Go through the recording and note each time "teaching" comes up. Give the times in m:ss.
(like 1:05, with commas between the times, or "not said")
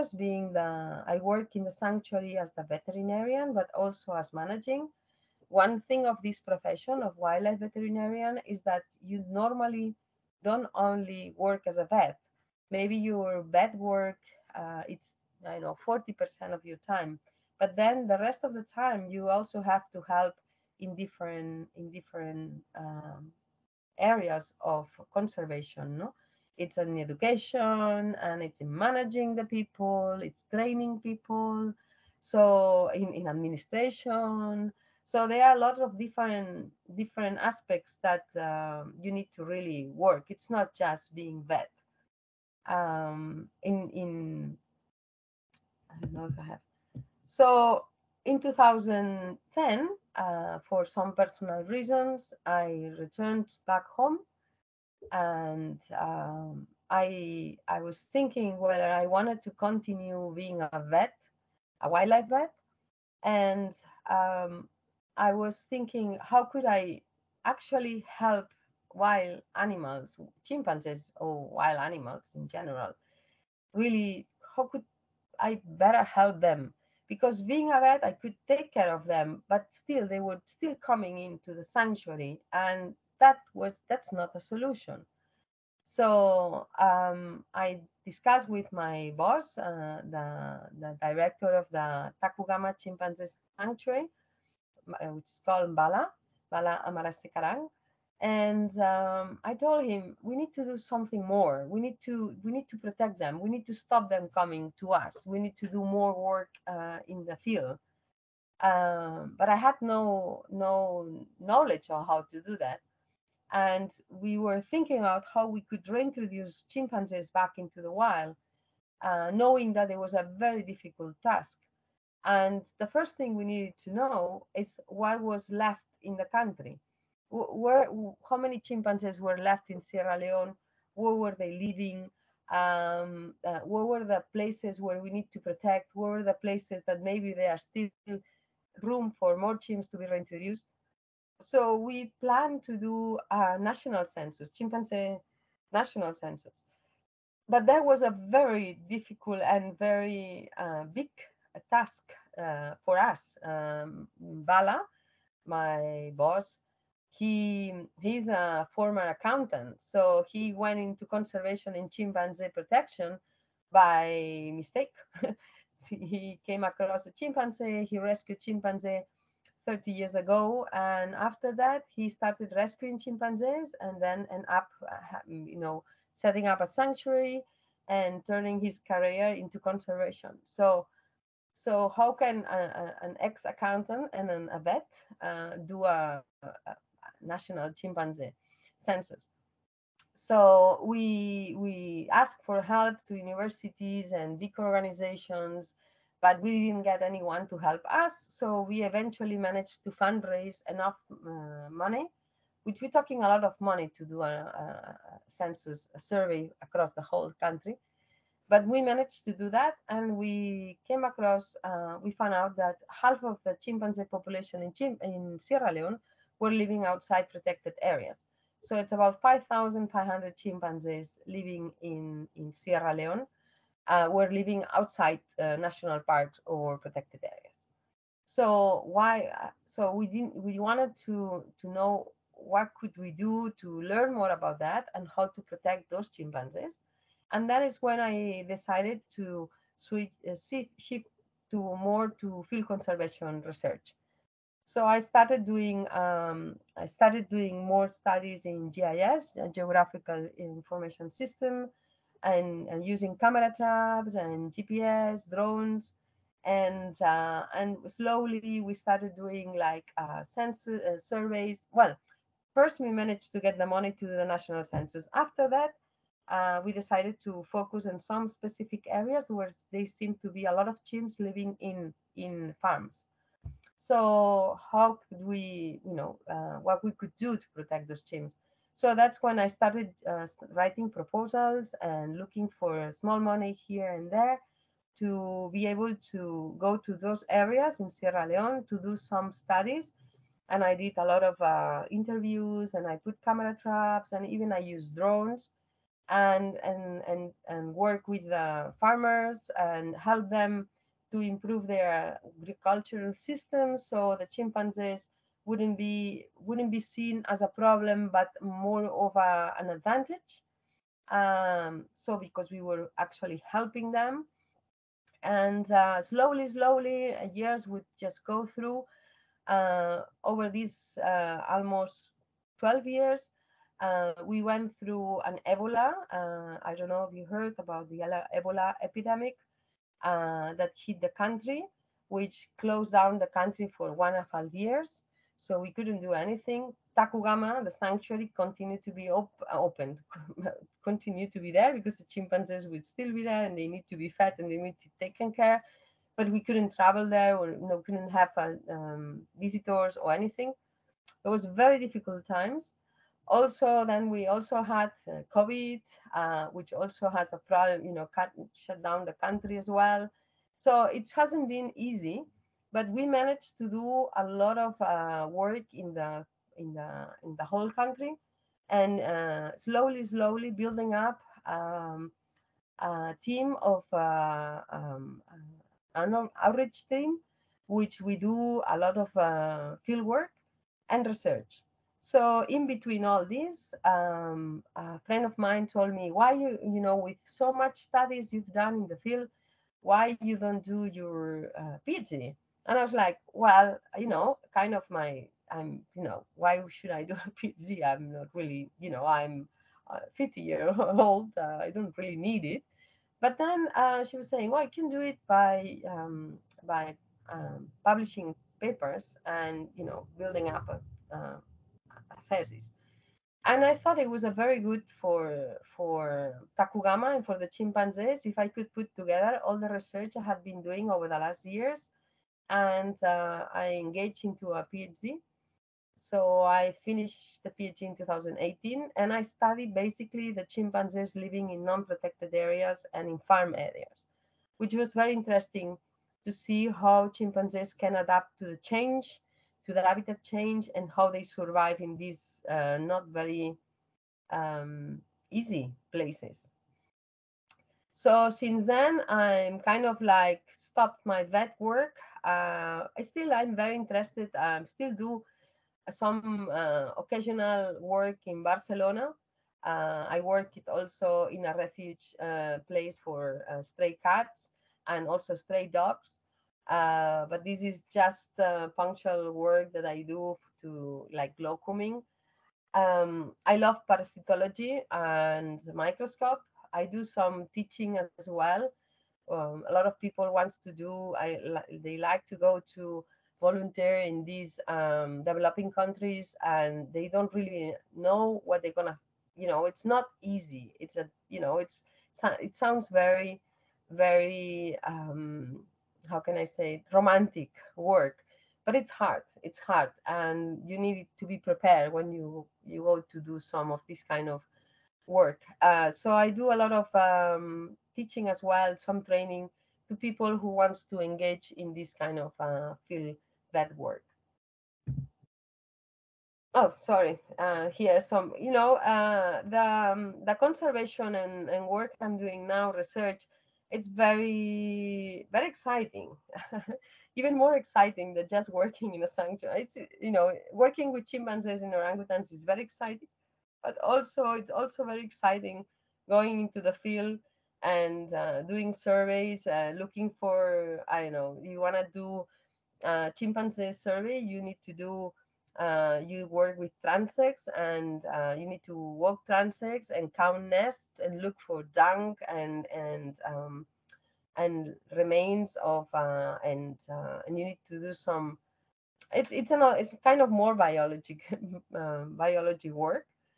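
7:57, 8:27.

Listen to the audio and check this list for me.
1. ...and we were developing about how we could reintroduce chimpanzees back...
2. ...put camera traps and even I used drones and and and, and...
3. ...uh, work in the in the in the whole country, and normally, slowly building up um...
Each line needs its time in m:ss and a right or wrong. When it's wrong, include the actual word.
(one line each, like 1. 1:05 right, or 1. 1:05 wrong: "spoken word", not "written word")
1. 1:53 wrong: "thinking", not "developing"
2. 4:52 right
3. 6:04 wrong: "slowly", not "normally".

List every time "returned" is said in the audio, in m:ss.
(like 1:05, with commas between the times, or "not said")
0:52.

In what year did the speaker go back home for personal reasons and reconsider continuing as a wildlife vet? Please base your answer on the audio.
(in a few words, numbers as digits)
2010.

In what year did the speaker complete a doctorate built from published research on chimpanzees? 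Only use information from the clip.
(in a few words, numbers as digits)
2018.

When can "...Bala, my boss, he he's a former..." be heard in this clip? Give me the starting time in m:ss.
2:34.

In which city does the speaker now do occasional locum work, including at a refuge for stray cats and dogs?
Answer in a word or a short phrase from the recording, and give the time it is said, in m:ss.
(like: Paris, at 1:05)
Barcelona, at 7:38.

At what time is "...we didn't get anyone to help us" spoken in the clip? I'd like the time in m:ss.
3:16.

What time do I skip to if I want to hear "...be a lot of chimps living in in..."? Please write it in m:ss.
4:30.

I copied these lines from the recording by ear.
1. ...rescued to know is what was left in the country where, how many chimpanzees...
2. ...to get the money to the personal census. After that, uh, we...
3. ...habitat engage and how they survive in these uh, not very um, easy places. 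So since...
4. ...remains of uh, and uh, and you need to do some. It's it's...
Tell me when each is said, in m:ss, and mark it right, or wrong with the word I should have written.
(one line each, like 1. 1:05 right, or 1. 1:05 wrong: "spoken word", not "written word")
1. 2:03 wrong: "needed", not "rescued"
2. 4:23 wrong: "national", not "personal"
3. 7:19 wrong: "change", not "engage"
4. 9:14 right.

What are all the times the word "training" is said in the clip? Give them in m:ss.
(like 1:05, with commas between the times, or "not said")
0:30, 8:29.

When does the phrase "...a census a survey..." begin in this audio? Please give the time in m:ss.
3:24.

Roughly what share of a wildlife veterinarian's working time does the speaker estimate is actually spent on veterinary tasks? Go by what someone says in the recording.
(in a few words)
40%.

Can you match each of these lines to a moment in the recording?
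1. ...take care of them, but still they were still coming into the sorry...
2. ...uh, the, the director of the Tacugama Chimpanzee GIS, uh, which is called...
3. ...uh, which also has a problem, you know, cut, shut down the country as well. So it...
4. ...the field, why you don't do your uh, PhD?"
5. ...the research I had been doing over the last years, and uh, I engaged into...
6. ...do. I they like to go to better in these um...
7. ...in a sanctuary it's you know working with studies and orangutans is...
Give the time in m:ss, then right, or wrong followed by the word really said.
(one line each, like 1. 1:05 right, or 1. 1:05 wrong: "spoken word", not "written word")
1. 1:18 wrong: "sanctuary", not "sorry"
2. 1:29 wrong: "Sanctuary", not "GIS"
3. 5:56 right
4. 6:28 right
5. 6:59 right
6. 8:00 wrong: "volunteer", not "better"
7. 8:48 wrong: "chimpanzees", not "studies".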